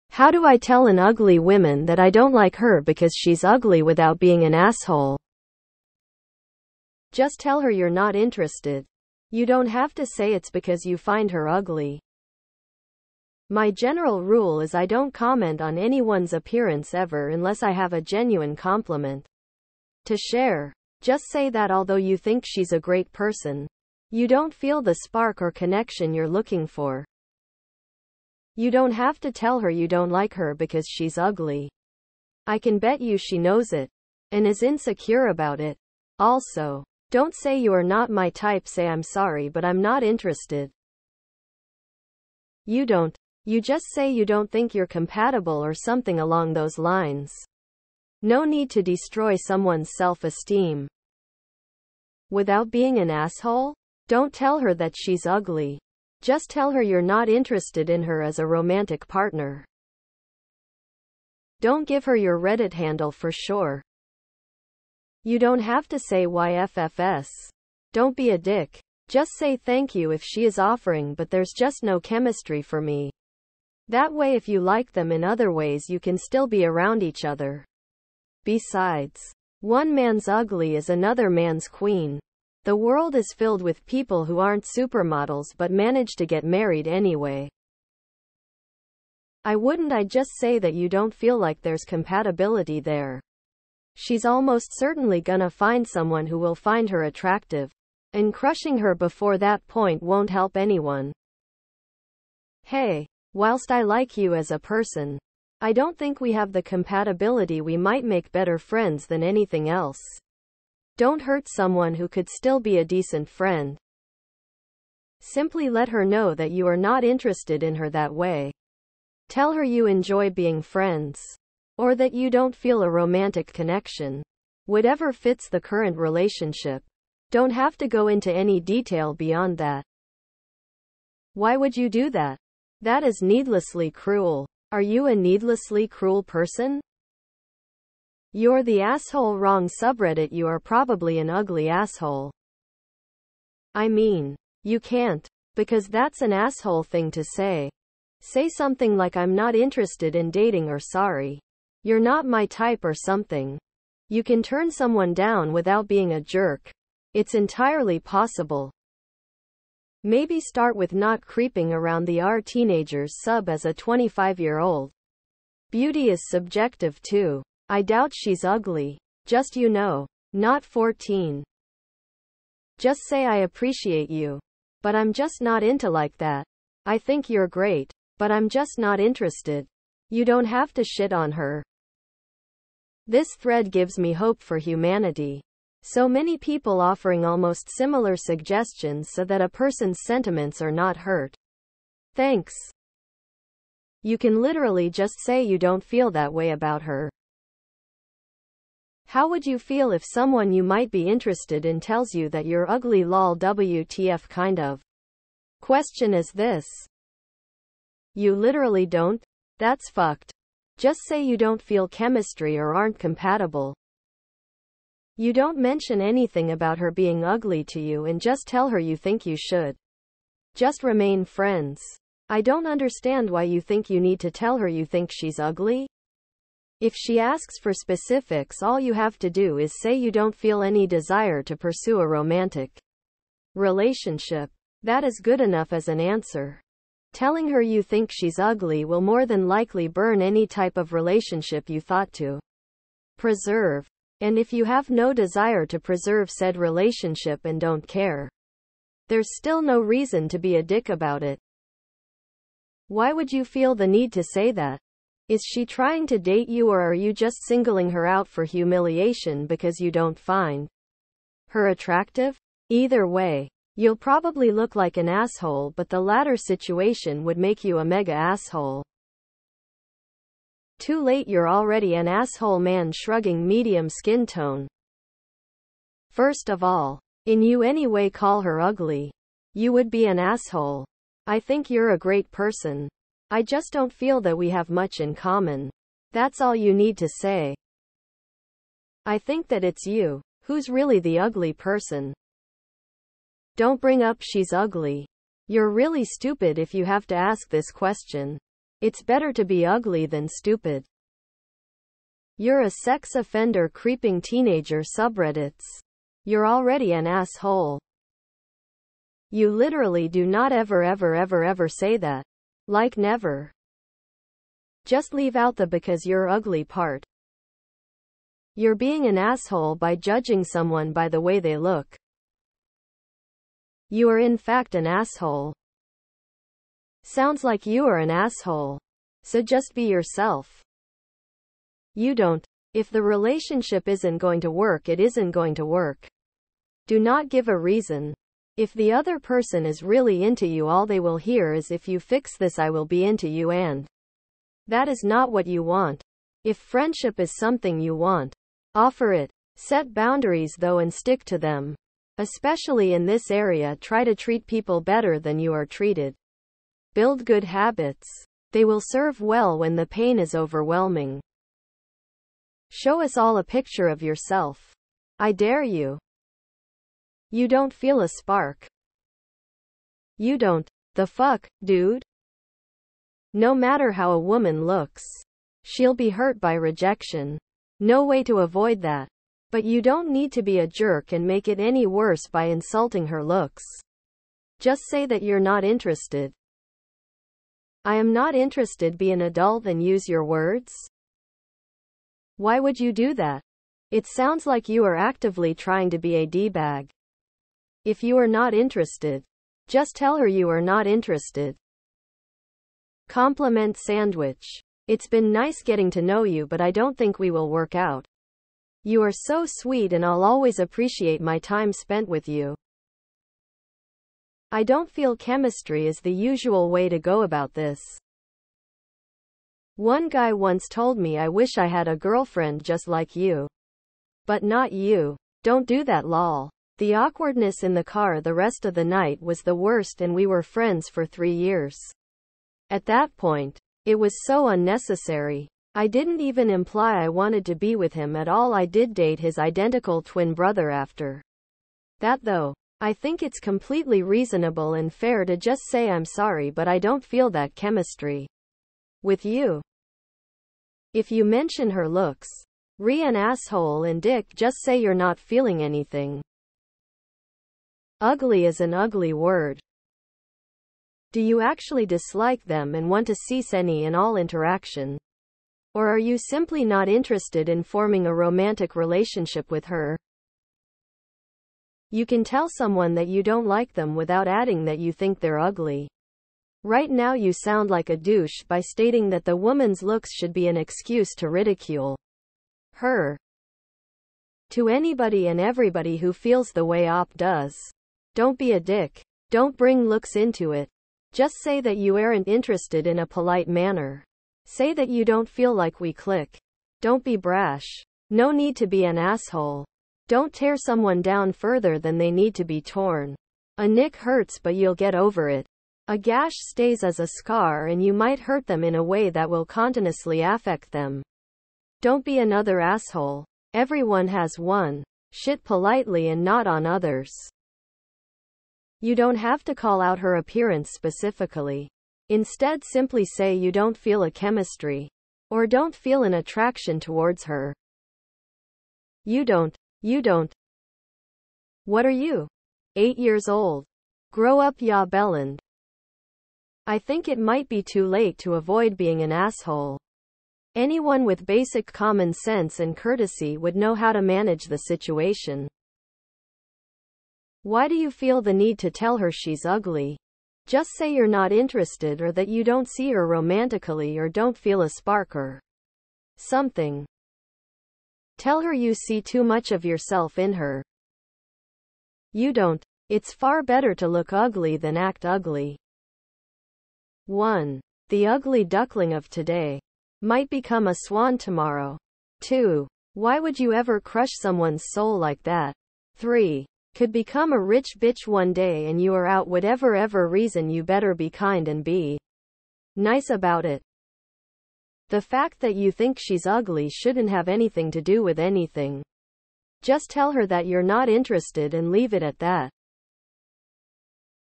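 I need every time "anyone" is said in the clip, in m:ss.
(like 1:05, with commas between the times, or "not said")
0:15, 1:40, 9:00.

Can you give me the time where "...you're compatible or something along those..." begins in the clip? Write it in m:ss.
0:44.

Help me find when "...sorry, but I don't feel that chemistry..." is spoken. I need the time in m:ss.
7:26.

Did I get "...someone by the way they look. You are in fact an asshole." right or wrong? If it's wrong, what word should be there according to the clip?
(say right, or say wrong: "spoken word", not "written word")
right.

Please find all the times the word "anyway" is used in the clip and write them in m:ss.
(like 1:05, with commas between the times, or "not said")
1:26, 4:37.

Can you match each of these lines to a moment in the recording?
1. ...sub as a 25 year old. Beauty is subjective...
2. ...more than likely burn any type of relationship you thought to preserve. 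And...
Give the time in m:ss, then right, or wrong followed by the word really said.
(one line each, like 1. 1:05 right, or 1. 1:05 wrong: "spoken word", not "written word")
1. 2:43 right
2. 3:58 right.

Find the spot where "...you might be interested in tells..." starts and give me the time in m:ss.
3:20.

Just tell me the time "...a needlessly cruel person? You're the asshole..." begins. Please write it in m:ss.
2:15.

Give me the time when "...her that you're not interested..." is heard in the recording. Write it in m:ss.
9:50.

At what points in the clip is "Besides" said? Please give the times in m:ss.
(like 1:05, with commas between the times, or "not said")
1:18.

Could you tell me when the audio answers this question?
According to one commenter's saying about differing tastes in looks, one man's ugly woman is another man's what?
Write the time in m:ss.
1:21.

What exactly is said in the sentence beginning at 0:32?
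I can bet you she knows it and is insecure about it.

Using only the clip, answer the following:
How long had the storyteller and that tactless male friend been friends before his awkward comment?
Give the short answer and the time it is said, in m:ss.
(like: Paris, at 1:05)
3 years, at 7:11.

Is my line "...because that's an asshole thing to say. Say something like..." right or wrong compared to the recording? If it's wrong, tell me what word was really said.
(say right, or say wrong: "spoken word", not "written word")
right.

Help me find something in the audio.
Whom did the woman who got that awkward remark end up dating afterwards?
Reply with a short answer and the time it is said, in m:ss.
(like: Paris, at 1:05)
His identical twin brother, at 7:19.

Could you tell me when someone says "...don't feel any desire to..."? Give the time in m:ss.
3:50.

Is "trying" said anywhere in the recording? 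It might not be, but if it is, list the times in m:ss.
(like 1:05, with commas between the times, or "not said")
4:15, 6:35.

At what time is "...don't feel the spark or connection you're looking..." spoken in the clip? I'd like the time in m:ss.
0:24.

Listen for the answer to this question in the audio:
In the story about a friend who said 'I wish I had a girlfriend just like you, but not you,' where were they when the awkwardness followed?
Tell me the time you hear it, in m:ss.
7:07.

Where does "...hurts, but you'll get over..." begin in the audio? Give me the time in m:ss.
8:23.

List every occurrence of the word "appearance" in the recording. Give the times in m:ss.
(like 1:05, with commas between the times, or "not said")
0:16, 8:40.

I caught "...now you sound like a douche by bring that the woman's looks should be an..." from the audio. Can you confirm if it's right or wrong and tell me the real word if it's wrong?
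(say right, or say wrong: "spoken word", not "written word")
wrong: "stating", not "bring".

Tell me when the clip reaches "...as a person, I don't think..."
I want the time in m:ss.
1:44.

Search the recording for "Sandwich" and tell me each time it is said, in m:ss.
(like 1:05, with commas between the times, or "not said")
6:43.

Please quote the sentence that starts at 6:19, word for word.
But you don't need to be a jerk and make it any worse by insulting her looks.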